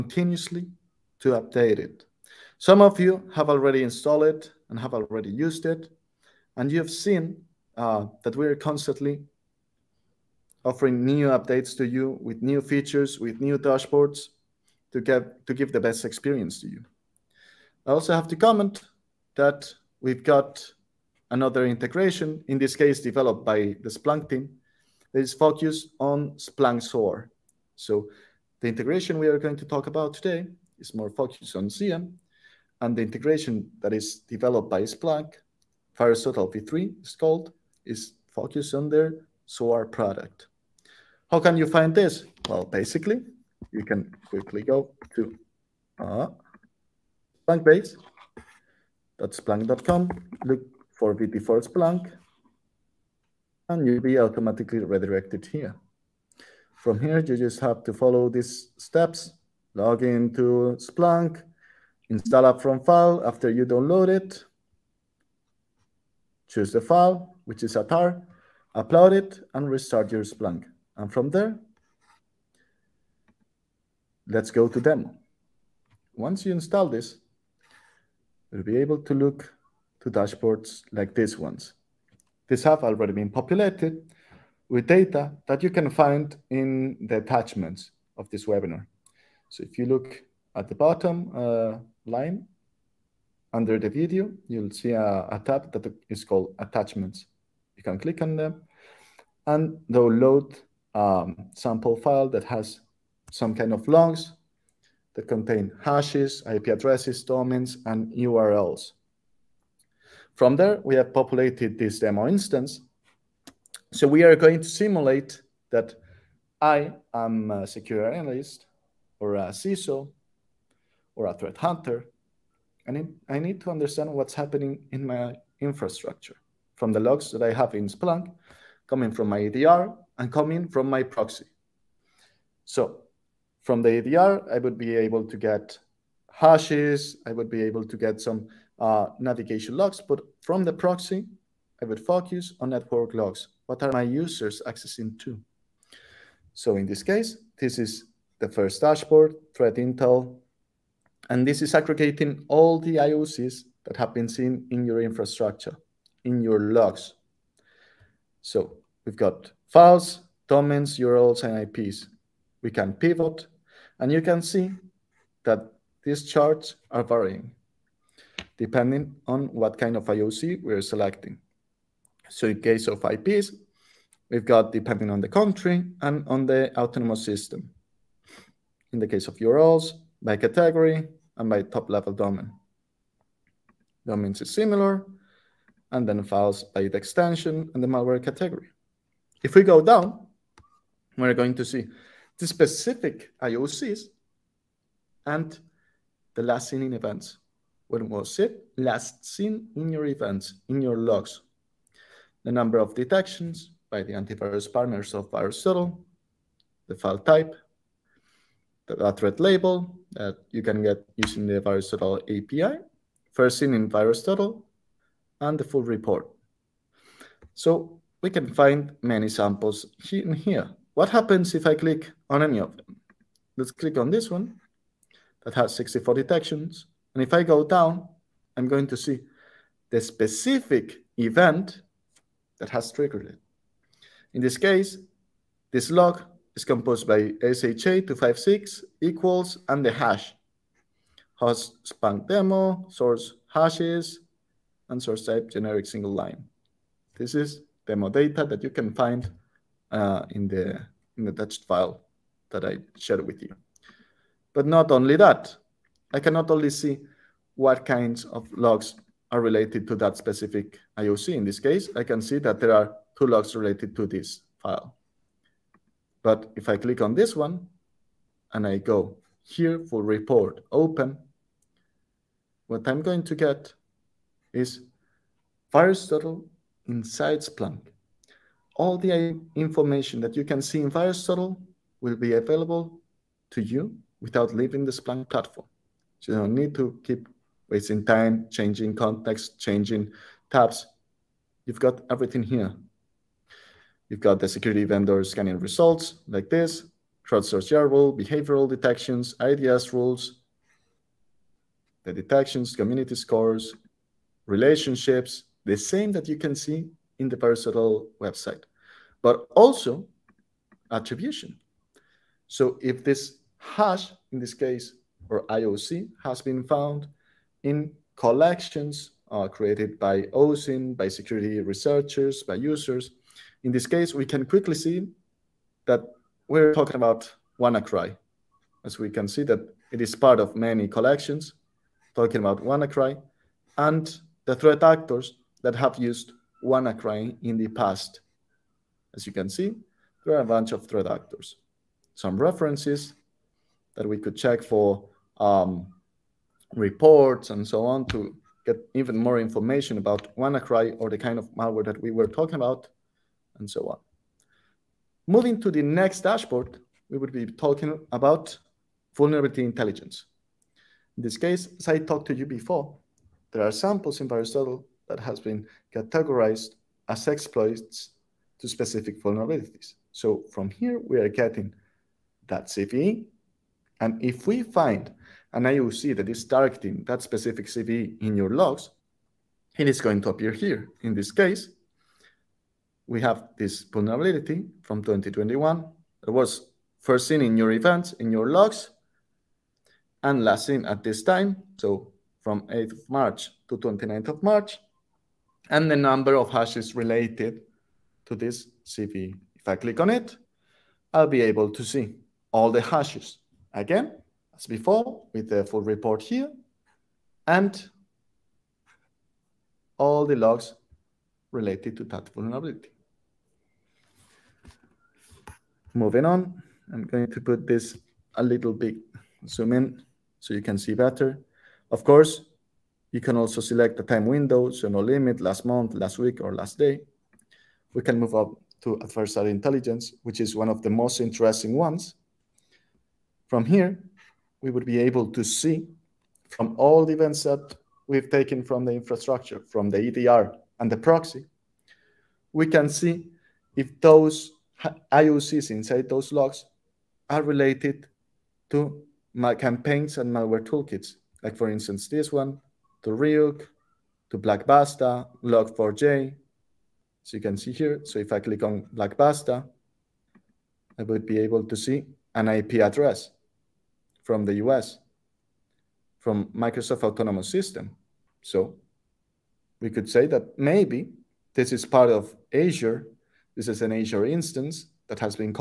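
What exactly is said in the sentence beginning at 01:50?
From there, we have populated this demo instance.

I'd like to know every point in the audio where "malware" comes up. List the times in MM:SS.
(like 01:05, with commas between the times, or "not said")
03:07, 05:51, 07:30.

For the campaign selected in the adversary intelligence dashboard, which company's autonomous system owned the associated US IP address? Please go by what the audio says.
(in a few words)
Microsoft.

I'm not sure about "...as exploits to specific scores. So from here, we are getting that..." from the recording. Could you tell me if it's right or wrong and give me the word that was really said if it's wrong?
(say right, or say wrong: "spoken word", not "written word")
wrong: "vulnerabilities", not "scores".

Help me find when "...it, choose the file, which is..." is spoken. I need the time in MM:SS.
01:04.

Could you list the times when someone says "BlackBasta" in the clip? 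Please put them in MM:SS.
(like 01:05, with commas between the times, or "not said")
07:34, 07:38.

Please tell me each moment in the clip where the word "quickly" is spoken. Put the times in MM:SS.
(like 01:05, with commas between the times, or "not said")
00:44, 05:24.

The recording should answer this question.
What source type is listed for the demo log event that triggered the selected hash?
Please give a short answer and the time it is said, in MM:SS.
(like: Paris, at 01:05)
generic single line, at 04:05.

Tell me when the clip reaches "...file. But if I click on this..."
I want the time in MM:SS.
04:24.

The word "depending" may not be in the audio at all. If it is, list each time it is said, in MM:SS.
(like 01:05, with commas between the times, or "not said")
02:48, 02:54.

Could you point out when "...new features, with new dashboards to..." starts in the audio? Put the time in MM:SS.
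00:12.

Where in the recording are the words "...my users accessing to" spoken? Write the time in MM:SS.
02:23.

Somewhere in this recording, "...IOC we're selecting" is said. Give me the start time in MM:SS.
02:50.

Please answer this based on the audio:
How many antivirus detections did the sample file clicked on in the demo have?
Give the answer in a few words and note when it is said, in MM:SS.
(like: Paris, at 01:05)
64, at 03:45.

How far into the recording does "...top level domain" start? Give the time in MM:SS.
03:01.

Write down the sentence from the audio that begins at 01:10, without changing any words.
And from there, let's go to demo.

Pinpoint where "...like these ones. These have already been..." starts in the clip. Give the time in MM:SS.
01:20.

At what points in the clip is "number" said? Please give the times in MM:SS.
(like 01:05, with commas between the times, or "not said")
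03:22, 06:35.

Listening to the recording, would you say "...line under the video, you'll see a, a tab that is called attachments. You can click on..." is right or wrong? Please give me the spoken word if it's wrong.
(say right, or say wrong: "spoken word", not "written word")
right.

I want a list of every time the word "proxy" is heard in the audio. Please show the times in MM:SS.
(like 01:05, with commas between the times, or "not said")
02:11, 02:20, 07:20.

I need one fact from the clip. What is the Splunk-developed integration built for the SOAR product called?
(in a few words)
VirusTotal V3.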